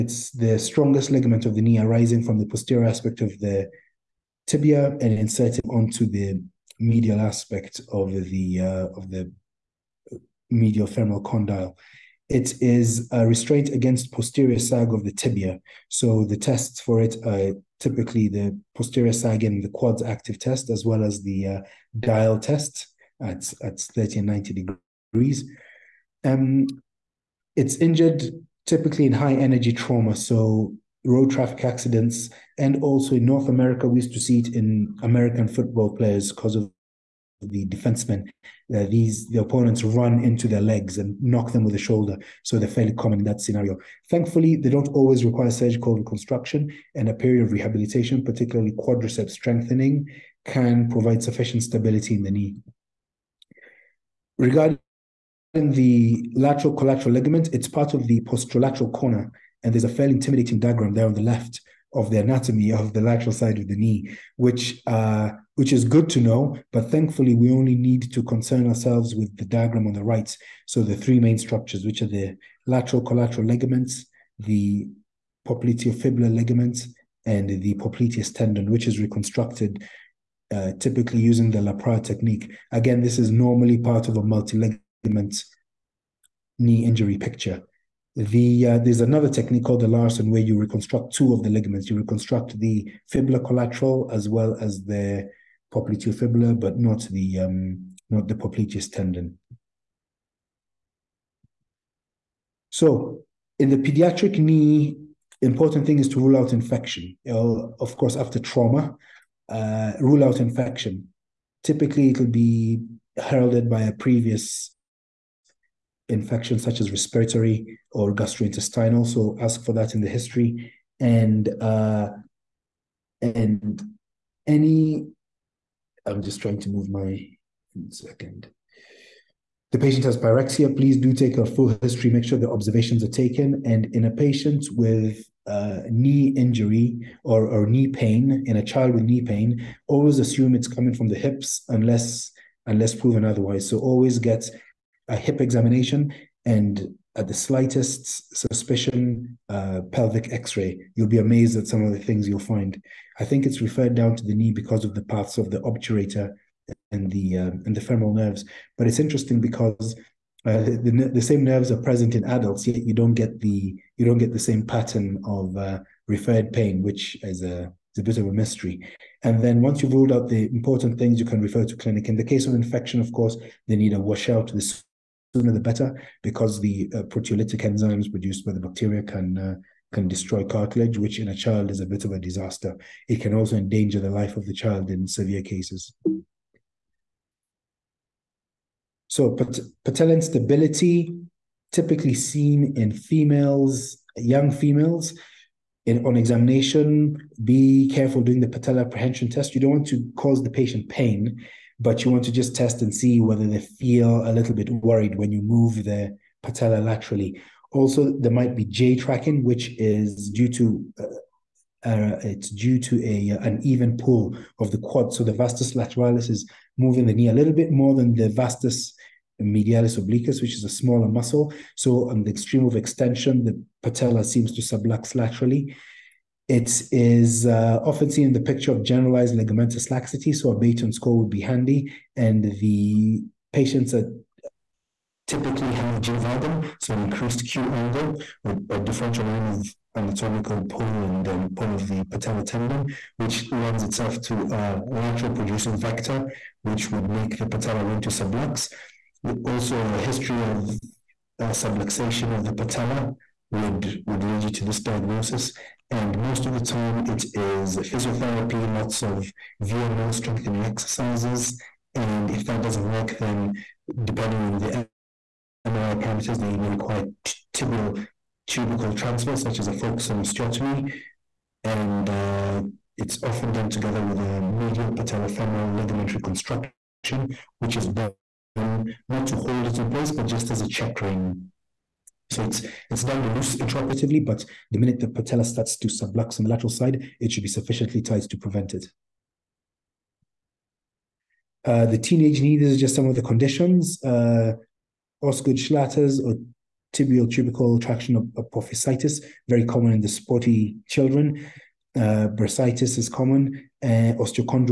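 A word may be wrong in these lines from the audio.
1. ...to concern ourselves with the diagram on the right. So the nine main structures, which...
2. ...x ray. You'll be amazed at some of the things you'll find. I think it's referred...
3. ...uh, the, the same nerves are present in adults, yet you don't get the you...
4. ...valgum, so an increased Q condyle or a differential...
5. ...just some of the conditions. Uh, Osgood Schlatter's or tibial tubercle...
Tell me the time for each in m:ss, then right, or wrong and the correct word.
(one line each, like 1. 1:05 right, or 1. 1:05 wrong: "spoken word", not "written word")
1. 1:08 wrong: "three", not "nine"
2. 2:30 right
3. 2:40 right
4. 3:56 wrong: "angle", not "condyle"
5. 4:52 right.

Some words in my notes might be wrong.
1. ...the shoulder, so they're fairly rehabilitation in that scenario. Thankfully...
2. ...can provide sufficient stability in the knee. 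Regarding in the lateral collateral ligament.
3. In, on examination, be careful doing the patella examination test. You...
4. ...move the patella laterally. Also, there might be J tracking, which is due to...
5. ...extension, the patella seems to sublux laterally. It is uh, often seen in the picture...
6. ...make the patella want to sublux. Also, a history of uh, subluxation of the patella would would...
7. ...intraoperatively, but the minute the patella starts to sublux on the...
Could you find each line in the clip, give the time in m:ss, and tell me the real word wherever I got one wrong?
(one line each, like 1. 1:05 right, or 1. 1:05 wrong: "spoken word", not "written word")
1. 0:41 wrong: "common", not "rehabilitation"
2. 0:50 right
3. 3:15 wrong: "apprehension", not "examination"
4. 3:25 right
5. 3:42 right
6. 4:07 right
7. 4:43 right.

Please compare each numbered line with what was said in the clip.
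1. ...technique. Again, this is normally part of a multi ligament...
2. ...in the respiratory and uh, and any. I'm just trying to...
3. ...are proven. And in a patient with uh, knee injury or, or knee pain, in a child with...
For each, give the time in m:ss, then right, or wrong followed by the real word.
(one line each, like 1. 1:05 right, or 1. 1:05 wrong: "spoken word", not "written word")
1. 1:22 right
2. 1:59 wrong: "history", not "respiratory"
3. 2:13 wrong: "taken", not "proven".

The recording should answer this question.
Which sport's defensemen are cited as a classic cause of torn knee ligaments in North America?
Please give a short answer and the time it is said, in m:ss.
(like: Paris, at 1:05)
American football, at 0:35.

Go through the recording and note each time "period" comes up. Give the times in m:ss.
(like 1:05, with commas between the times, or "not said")
0:47.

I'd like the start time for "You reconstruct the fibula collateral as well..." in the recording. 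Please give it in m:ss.
1:31.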